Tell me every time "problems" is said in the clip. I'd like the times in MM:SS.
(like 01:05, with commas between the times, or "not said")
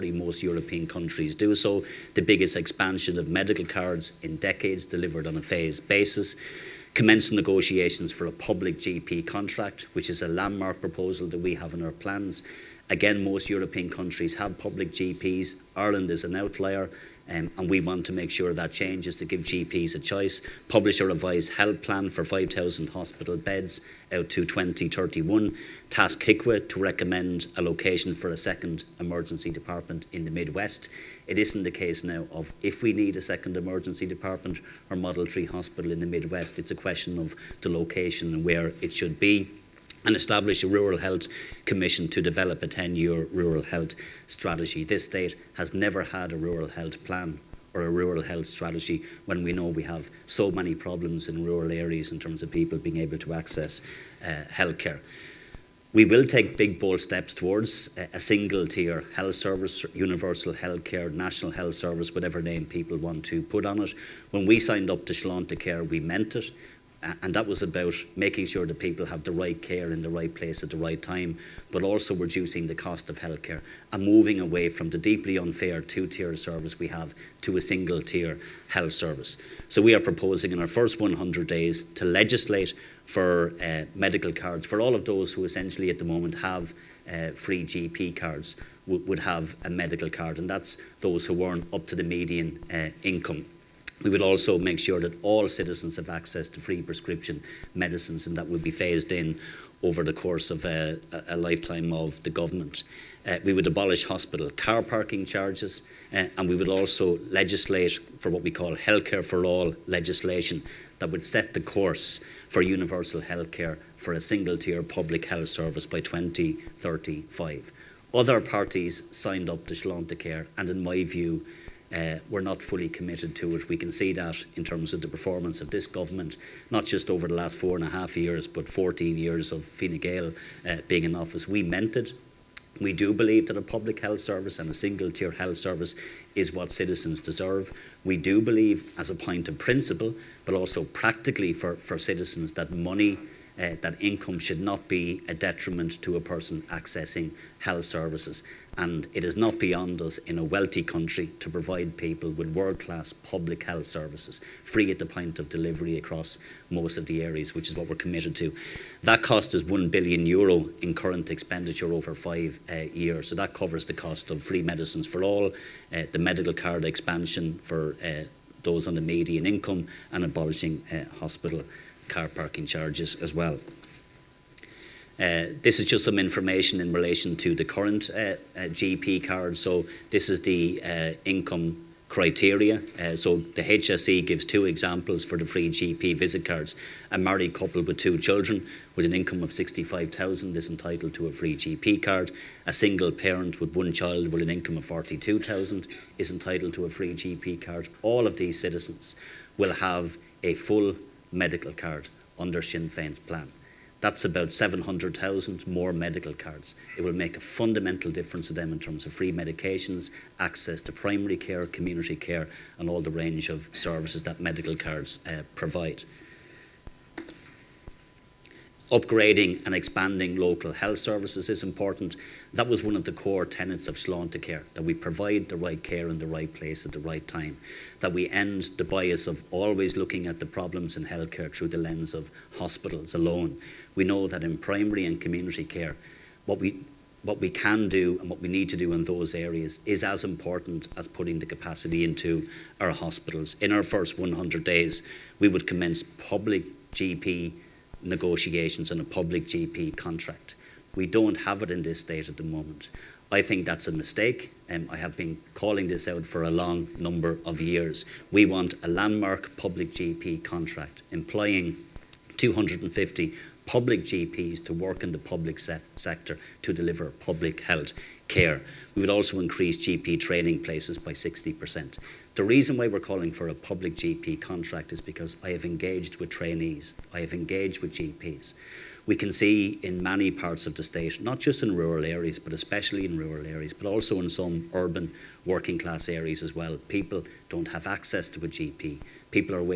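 00:50, 03:50.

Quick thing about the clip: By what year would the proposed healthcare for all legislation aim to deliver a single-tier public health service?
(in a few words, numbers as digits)
2035.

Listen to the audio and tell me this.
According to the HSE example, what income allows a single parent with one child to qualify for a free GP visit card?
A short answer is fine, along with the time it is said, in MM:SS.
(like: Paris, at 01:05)
42,000, at 03:14.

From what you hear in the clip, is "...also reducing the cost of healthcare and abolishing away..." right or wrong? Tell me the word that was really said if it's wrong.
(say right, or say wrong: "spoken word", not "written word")
wrong: "moving", not "abolishing".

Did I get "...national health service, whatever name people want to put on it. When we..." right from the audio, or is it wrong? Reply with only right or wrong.
right.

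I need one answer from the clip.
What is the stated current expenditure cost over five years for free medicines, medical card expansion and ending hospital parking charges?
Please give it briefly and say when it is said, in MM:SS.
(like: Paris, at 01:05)
1 billion euro, at 02:39.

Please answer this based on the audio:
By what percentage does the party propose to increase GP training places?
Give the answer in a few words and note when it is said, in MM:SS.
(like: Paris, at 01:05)
60%, at 04:31.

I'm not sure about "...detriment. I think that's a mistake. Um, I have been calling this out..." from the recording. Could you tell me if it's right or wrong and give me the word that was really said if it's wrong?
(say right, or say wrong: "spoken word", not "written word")
wrong: "moment", not "detriment".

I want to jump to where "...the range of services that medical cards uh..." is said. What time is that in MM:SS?
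03:33.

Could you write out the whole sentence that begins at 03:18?
All of these citizens will have a full medical card under Sinn Féin's plan.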